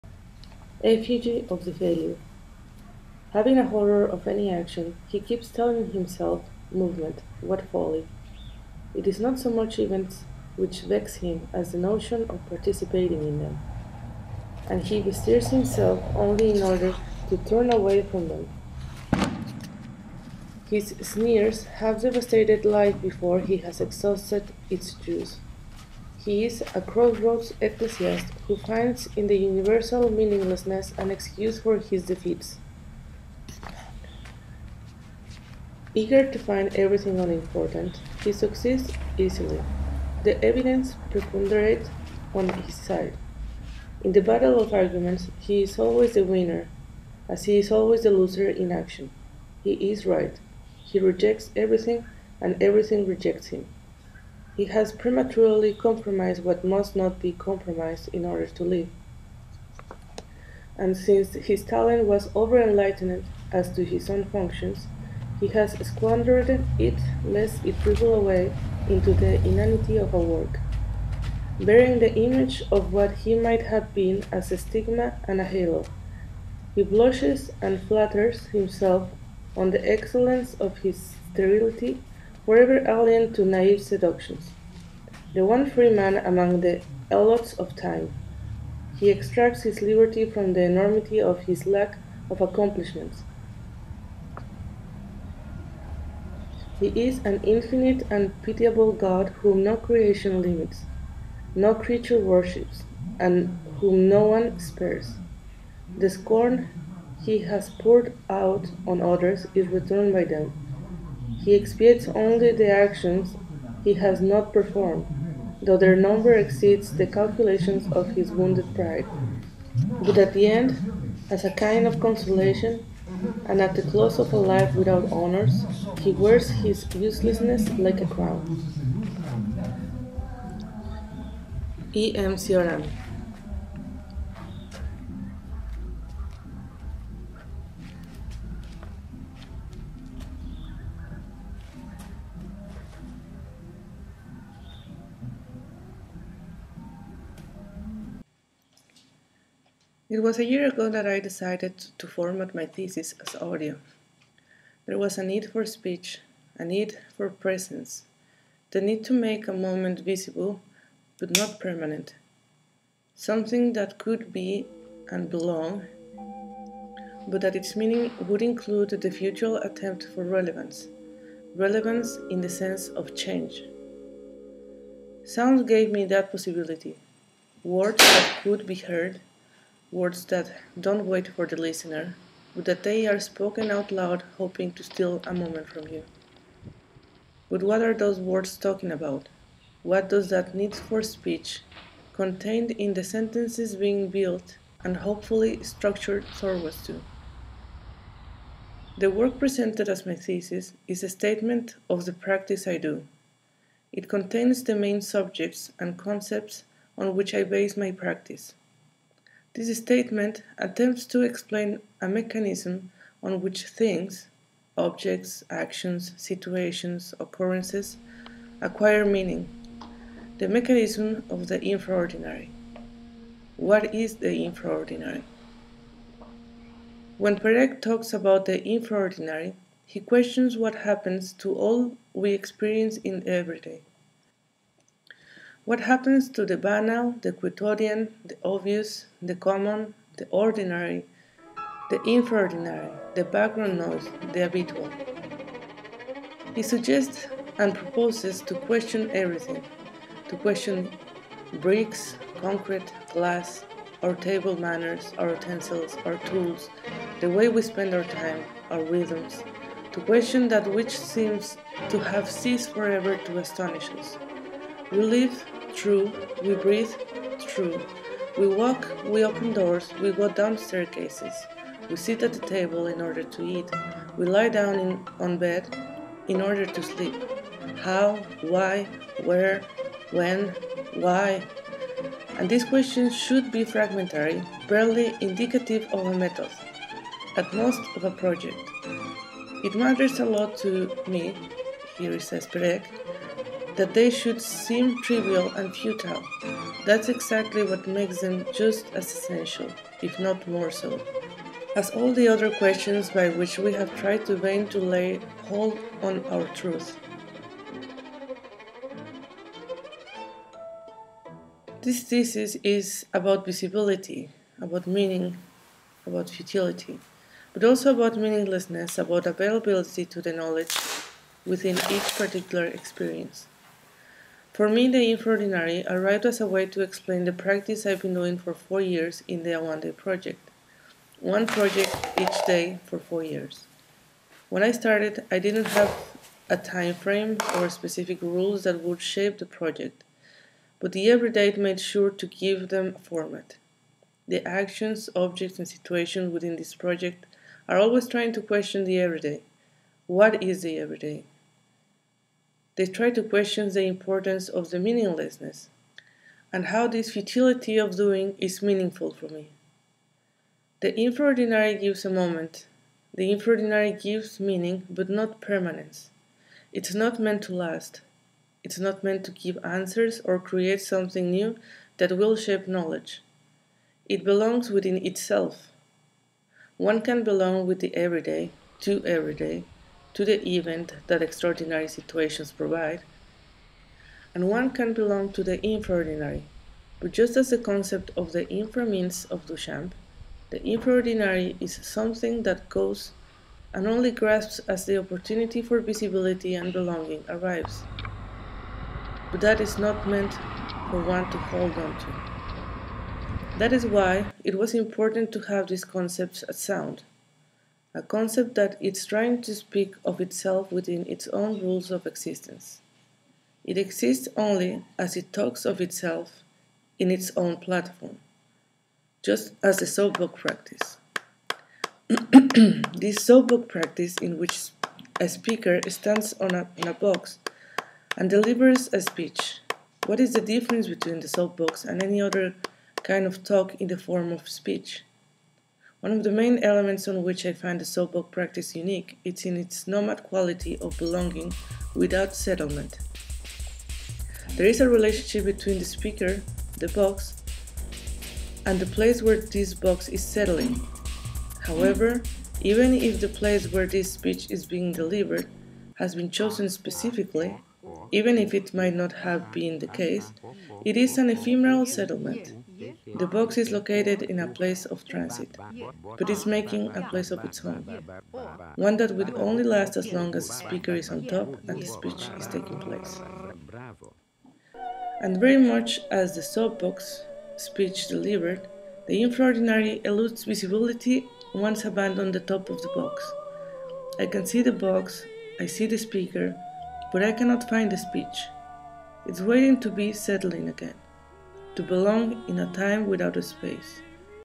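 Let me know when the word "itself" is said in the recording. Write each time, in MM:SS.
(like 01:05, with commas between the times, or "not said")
06:15, 06:50, 06:55.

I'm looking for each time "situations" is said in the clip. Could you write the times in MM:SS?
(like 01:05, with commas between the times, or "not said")
03:36, 05:45, 06:21.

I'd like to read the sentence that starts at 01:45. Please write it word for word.
The scorn he has poured out on others is returned by them.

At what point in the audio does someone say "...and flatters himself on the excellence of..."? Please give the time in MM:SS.
01:17.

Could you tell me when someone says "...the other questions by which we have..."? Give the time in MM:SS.
05:02.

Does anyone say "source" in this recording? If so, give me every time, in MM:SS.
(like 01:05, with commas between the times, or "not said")
not said.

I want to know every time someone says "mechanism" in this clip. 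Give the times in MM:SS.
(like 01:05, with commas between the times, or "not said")
03:32, 03:40.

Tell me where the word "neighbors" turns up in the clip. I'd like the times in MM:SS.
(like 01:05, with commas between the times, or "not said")
not said.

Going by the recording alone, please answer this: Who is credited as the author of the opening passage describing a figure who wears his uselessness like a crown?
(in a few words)
E. M. Cioran.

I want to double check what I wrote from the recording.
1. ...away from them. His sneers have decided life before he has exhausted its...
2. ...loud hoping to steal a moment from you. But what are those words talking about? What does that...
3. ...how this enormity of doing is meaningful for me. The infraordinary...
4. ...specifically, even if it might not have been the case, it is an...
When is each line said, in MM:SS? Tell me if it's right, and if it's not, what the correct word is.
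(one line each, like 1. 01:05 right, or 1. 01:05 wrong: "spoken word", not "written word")
1. 00:17 wrong: "devastated", not "decided"
2. 03:03 right
3. 05:56 wrong: "futility", not "enormity"
4. 07:36 right.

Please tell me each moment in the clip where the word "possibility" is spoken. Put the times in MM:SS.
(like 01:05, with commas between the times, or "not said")
02:56.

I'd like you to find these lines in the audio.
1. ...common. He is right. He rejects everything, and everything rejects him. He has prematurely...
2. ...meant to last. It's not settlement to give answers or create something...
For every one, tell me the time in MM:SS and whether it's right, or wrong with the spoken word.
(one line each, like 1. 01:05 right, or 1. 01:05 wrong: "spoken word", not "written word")
1. 00:48 wrong: "action", not "common"
2. 06:07 wrong: "meant", not "settlement".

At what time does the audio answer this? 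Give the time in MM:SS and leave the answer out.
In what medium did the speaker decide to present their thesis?
02:33.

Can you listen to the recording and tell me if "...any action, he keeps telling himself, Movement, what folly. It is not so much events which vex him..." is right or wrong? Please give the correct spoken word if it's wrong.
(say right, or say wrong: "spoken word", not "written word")
right.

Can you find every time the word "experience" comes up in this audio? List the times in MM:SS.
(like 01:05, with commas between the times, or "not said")
03:52, 05:22.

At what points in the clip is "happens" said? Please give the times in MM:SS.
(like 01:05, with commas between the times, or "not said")
03:50, 03:55.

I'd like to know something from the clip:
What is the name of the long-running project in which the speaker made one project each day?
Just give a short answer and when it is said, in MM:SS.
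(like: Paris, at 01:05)
One Day Project, at 05:29.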